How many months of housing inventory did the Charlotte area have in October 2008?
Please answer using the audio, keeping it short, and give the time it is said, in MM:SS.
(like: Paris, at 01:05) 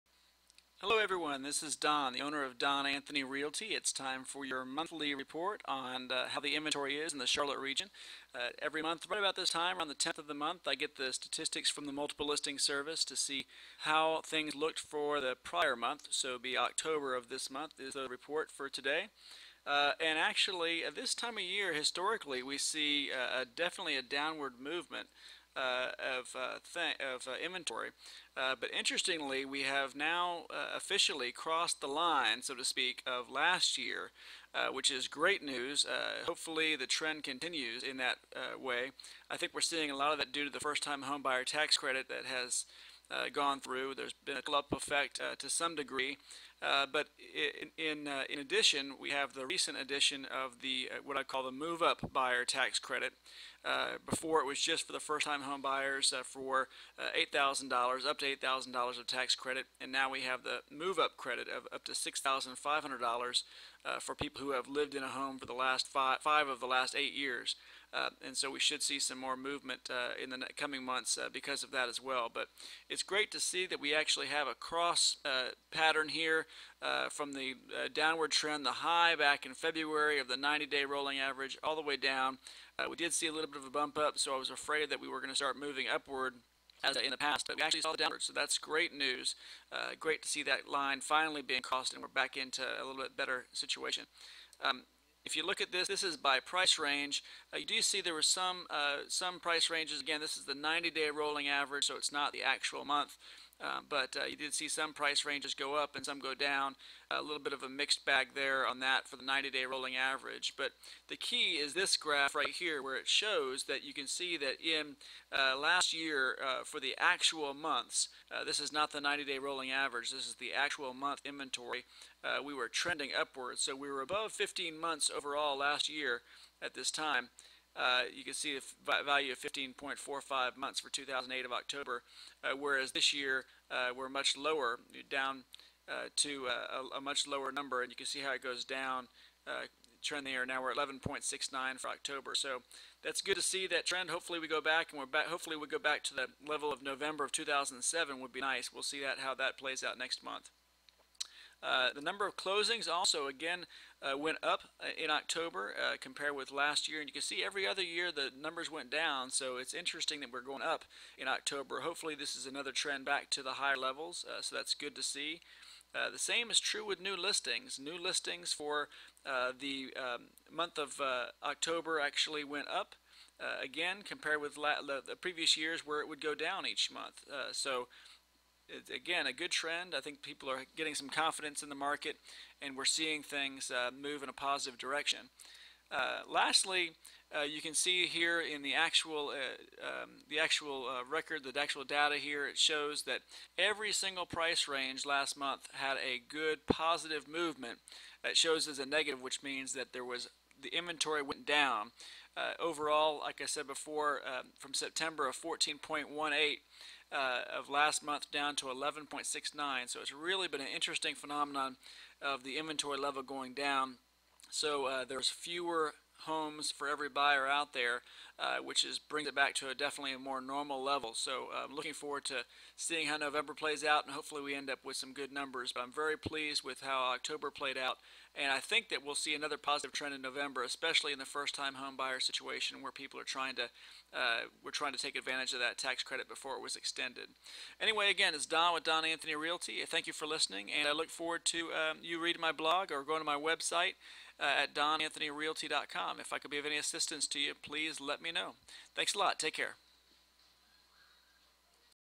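15.45 months, at 02:09.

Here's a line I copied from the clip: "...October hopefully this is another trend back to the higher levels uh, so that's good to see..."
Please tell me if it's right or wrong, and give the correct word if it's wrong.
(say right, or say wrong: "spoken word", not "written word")
right.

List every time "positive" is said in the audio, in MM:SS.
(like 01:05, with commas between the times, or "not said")
03:04, 03:16, 03:49.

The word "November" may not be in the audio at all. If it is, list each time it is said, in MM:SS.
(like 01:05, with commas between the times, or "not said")
02:26, 03:43, 03:50.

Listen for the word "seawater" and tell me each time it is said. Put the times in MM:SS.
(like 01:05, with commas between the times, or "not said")
not said.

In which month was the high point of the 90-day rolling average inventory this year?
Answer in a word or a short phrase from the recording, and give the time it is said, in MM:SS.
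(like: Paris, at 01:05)
February, at 01:19.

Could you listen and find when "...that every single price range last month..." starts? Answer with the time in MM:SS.
03:13.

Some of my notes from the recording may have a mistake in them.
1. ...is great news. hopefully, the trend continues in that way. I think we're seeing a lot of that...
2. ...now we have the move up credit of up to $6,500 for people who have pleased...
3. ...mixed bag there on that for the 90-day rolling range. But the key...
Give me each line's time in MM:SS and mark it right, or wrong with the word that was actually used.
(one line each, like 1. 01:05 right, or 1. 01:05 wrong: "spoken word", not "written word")
1. 00:34 right
2. 00:59 wrong: "lived", not "pleased"
3. 01:47 wrong: "average", not "range".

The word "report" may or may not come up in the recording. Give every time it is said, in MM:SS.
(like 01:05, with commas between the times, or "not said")
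00:05, 00:18.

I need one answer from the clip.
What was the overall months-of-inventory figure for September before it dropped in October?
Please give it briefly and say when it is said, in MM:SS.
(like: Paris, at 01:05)
14.18, at 03:25.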